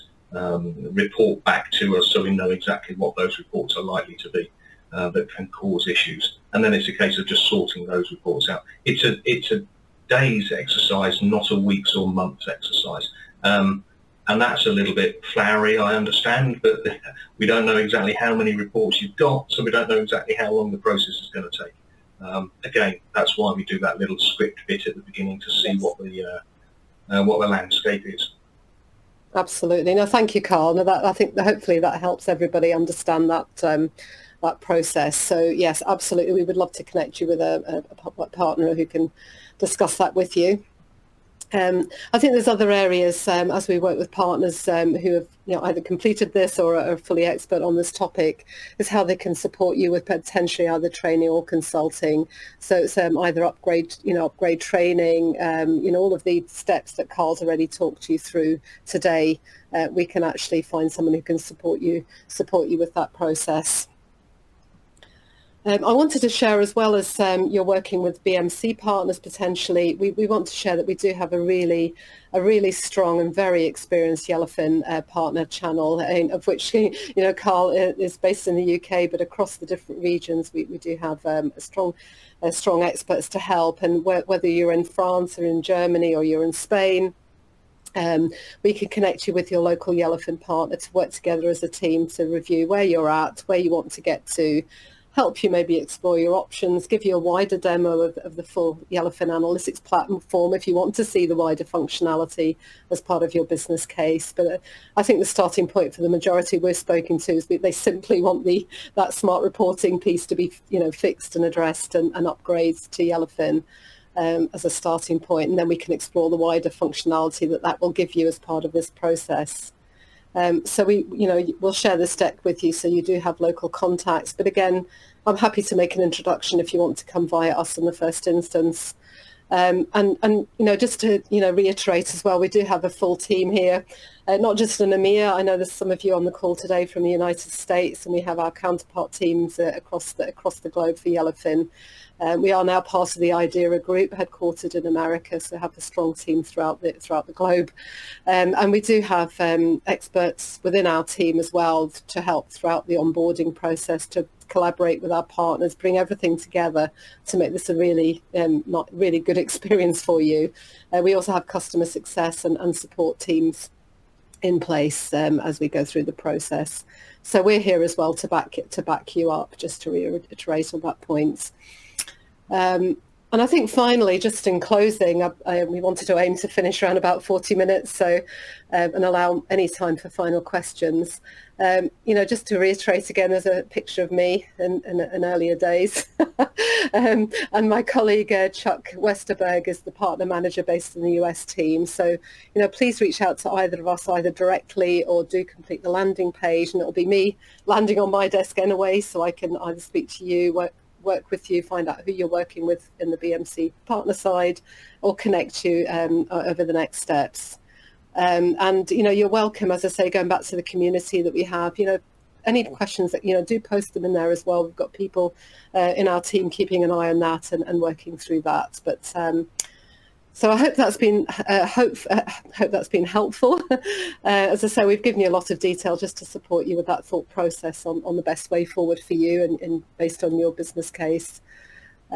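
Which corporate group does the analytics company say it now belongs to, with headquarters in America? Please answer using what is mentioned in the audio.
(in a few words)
IDERA.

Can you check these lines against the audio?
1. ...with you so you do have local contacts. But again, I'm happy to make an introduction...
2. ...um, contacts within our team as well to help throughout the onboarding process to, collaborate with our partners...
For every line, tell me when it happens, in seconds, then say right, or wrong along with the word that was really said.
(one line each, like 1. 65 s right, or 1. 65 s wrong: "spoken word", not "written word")
1. 122 s right
2. 149 s wrong: "experts", not "contacts".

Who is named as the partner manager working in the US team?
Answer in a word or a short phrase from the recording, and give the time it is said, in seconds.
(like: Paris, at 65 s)
Chuck Westerberg, at 188 s.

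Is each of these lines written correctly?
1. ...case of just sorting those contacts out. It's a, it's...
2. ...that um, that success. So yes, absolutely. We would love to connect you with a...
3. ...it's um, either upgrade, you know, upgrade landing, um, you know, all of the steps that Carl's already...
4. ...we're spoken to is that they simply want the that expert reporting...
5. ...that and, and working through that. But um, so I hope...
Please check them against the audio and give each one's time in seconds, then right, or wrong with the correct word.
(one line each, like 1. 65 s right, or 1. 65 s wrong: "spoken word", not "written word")
1. 6 s wrong: "reports", not "contacts"
2. 33 s wrong: "process", not "success"
3. 52 s wrong: "training", not "landing"
4. 106 s wrong: "smart", not "expert"
5. 217 s right.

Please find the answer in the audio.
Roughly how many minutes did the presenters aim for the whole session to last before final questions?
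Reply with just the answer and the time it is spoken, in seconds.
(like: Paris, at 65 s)
40 minutes, at 177 s.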